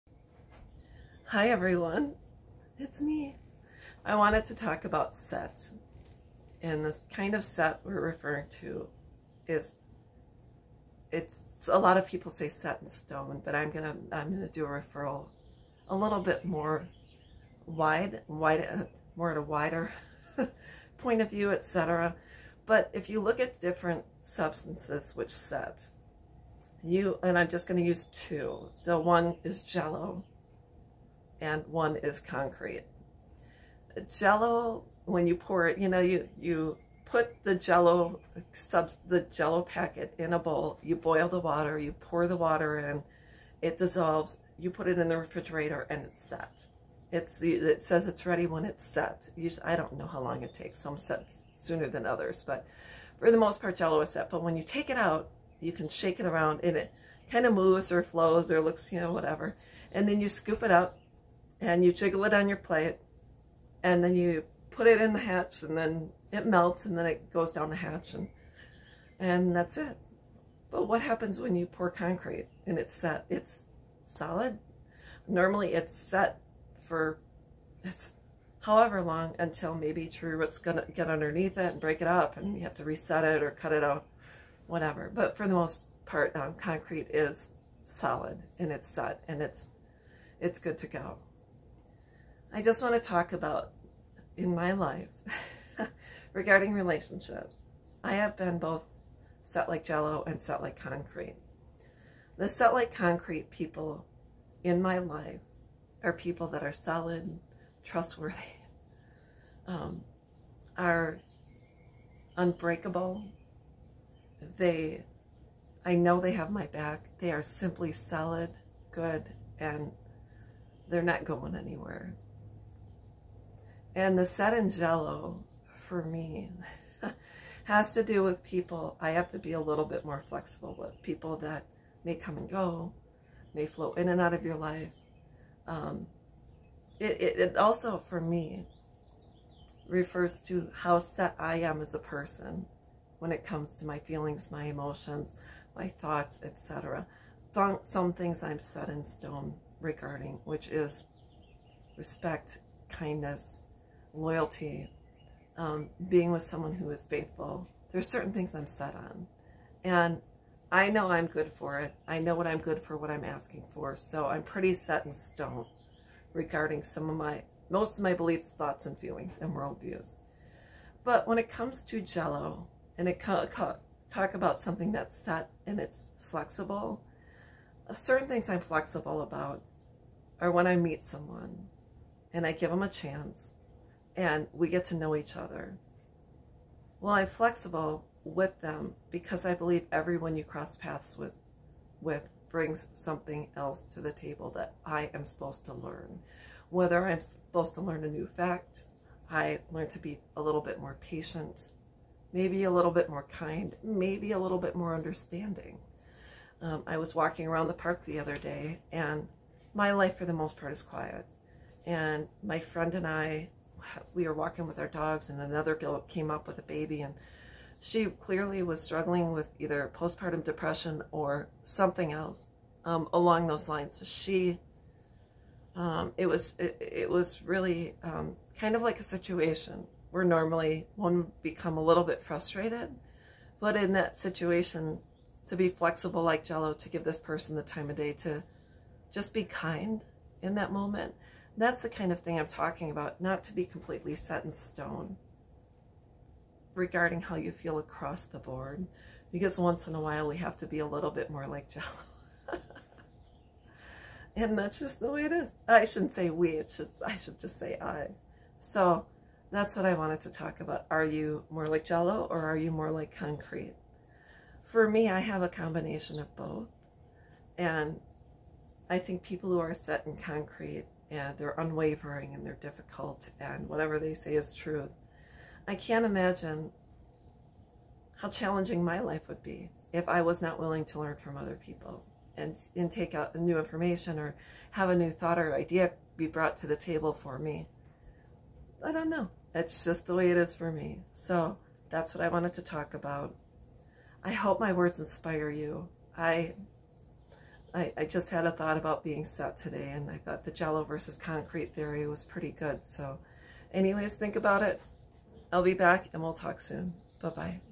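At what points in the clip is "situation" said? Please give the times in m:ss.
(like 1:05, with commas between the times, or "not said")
3:49, 3:54.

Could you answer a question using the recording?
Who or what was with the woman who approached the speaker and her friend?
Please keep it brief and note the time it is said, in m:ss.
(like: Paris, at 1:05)
A baby, at 3:36.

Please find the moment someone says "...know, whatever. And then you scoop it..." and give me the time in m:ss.
0:59.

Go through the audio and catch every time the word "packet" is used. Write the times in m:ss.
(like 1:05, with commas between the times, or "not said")
0:39.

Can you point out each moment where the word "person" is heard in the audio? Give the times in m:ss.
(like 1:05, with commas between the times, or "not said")
2:21, 3:57.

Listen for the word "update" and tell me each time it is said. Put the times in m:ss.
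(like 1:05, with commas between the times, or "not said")
not said.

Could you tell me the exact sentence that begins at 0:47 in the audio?
It's, it says it's ready when it's set.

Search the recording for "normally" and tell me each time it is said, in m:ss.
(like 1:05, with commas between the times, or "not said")
1:15, 3:50.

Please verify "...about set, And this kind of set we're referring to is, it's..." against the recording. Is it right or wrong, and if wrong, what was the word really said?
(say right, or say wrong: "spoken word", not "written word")
right.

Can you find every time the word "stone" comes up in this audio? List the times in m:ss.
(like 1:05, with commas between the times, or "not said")
0:12, 2:29, 2:45, 4:04.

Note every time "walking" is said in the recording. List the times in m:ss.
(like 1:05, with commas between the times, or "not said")
3:27, 3:34.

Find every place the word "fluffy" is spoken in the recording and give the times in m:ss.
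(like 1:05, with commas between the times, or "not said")
not said.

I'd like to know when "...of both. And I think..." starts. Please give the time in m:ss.
4:26.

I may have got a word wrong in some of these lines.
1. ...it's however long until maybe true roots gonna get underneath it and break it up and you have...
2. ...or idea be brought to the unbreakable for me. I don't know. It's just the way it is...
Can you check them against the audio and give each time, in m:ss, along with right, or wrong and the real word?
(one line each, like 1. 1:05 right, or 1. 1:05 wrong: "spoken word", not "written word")
1. 1:17 right
2. 4:45 wrong: "table", not "unbreakable".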